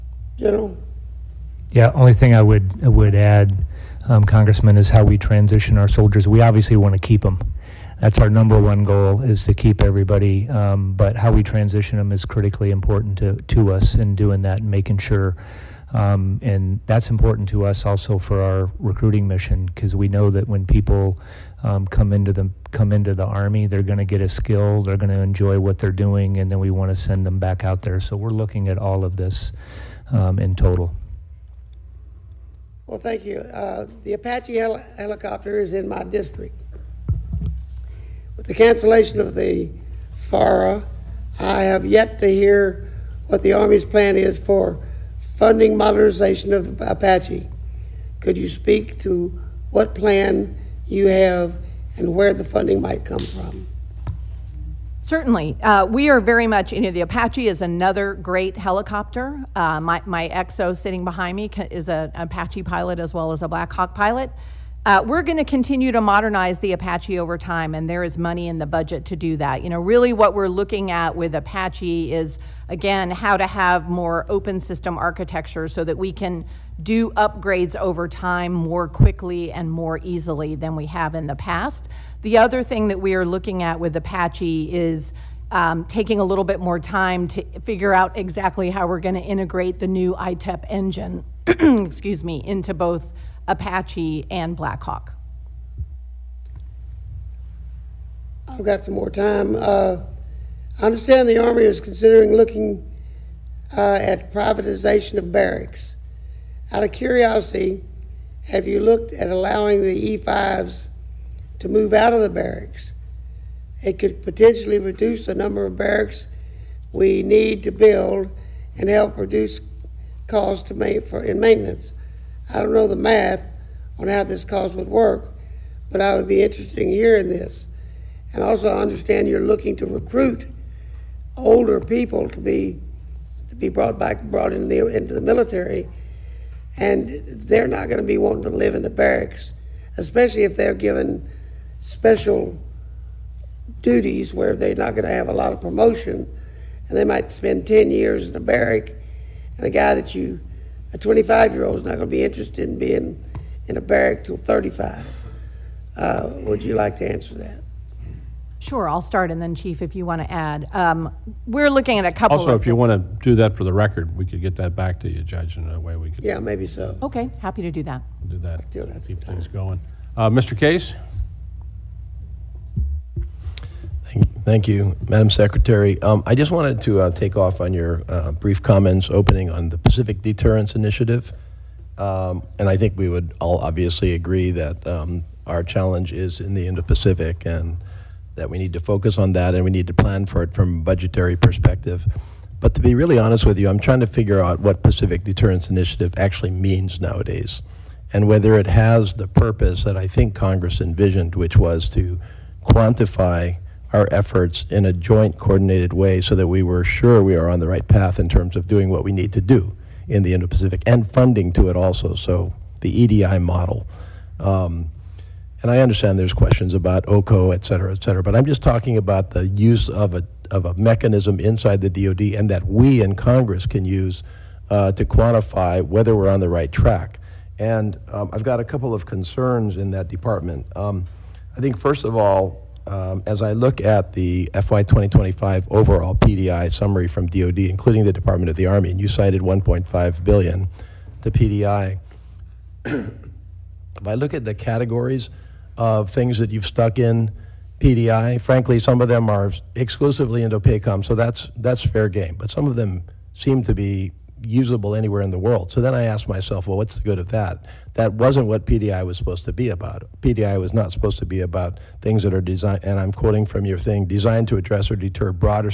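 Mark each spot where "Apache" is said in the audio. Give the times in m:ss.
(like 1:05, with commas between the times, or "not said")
0:34, 0:46, 0:57, 1:02, 1:06, 1:11, 1:23, 1:33.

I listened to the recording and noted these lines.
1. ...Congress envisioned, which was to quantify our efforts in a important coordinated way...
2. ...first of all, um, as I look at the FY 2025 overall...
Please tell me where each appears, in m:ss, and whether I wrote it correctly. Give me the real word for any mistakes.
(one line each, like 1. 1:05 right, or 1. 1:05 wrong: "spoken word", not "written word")
1. 3:20 wrong: "joint", not "important"
2. 3:51 right.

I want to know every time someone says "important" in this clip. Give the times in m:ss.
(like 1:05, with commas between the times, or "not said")
0:12, 0:17.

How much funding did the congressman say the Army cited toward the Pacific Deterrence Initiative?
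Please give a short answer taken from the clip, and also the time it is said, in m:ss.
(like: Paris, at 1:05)
1.5 billion, at 3:59.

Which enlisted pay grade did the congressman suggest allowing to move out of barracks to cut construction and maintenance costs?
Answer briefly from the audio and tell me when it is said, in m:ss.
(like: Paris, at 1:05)
E5, at 1:50.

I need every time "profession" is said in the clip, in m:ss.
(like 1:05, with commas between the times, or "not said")
not said.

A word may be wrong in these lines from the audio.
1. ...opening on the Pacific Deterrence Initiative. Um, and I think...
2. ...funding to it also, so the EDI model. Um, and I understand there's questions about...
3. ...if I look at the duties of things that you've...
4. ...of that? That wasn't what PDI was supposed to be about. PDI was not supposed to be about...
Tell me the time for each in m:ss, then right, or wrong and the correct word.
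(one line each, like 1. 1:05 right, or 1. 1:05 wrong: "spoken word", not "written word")
1. 2:59 right
2. 3:31 right
3. 4:02 wrong: "categories", not "duties"
4. 4:17 right.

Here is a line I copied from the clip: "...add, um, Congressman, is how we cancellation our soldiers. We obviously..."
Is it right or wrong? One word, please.
wrong.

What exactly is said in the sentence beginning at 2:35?
Uh, would you like to answer that?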